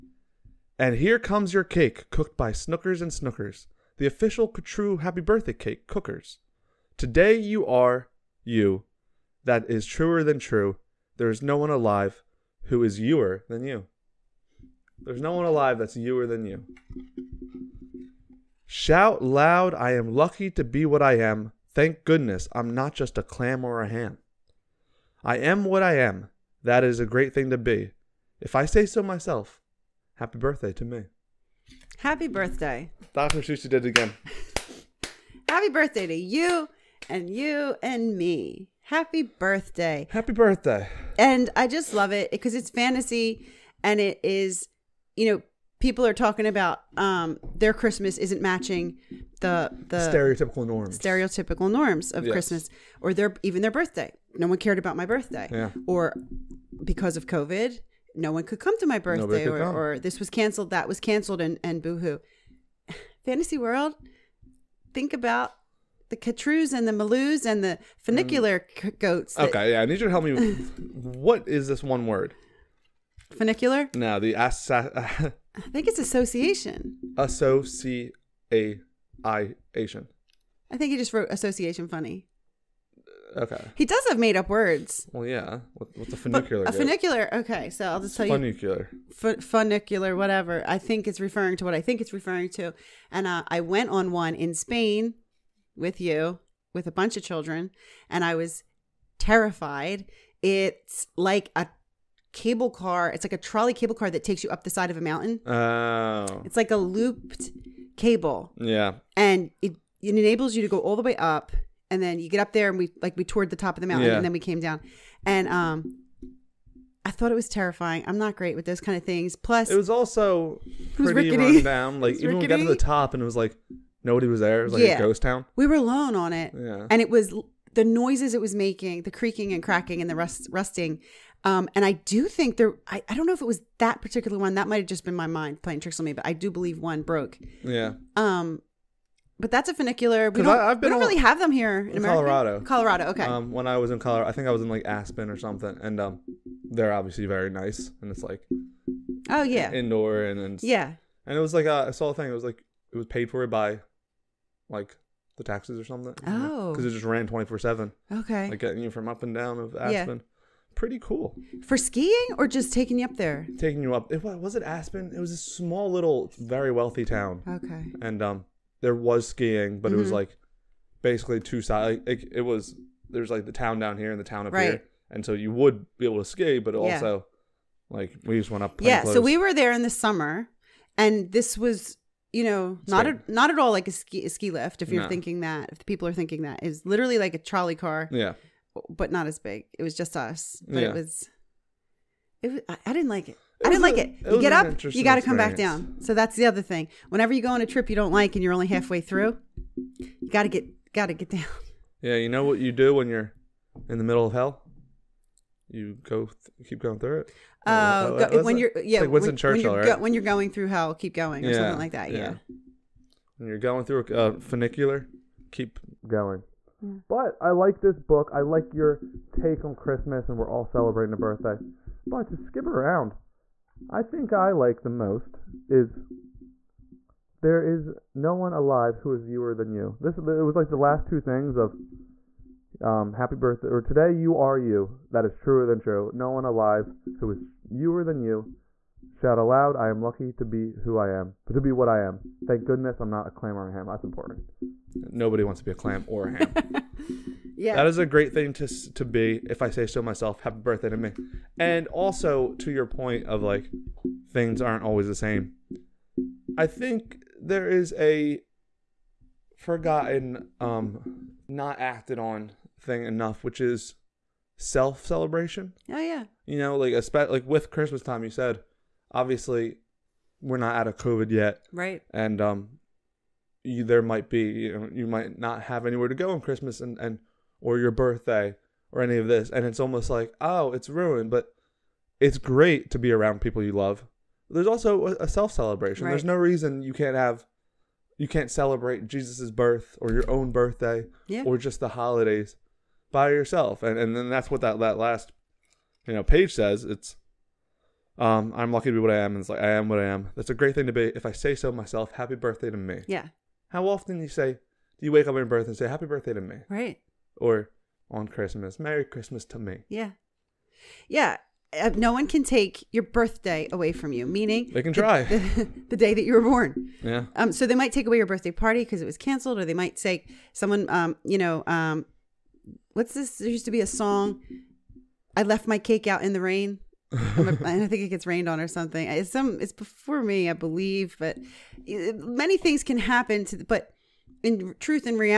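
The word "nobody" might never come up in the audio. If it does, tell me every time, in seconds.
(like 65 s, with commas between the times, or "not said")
124 s, 244 s.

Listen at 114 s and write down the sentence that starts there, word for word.
and then we came down and um I thought it was terrifying.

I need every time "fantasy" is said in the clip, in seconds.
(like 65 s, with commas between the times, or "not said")
42 s, 63 s.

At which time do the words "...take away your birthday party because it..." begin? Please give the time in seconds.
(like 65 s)
317 s.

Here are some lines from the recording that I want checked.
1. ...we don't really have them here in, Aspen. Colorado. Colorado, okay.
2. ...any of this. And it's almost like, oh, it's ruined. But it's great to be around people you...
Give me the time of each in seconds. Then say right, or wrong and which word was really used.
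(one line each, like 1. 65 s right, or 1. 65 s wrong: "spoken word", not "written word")
1. 140 s wrong: "America", not "Aspen"
2. 279 s right.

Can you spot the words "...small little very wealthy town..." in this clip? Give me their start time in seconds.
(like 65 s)
165 s.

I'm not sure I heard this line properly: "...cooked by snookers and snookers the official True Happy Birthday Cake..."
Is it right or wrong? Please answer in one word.
right.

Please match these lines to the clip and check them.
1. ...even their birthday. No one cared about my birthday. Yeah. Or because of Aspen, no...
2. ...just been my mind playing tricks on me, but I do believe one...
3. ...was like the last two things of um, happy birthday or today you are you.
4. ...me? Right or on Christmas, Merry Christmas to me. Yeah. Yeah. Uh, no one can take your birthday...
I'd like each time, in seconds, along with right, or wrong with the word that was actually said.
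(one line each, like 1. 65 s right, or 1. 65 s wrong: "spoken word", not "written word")
1. 53 s wrong: "COVID", not "Aspen"
2. 134 s right
3. 230 s right
4. 306 s right.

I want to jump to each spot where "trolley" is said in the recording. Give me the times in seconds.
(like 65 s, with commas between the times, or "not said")
103 s, 187 s.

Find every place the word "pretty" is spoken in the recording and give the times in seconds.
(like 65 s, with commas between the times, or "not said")
120 s, 160 s.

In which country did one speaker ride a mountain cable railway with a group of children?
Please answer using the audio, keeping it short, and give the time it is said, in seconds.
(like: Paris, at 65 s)
Spain, at 94 s.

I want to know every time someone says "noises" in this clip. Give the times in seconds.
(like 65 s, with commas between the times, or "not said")
127 s.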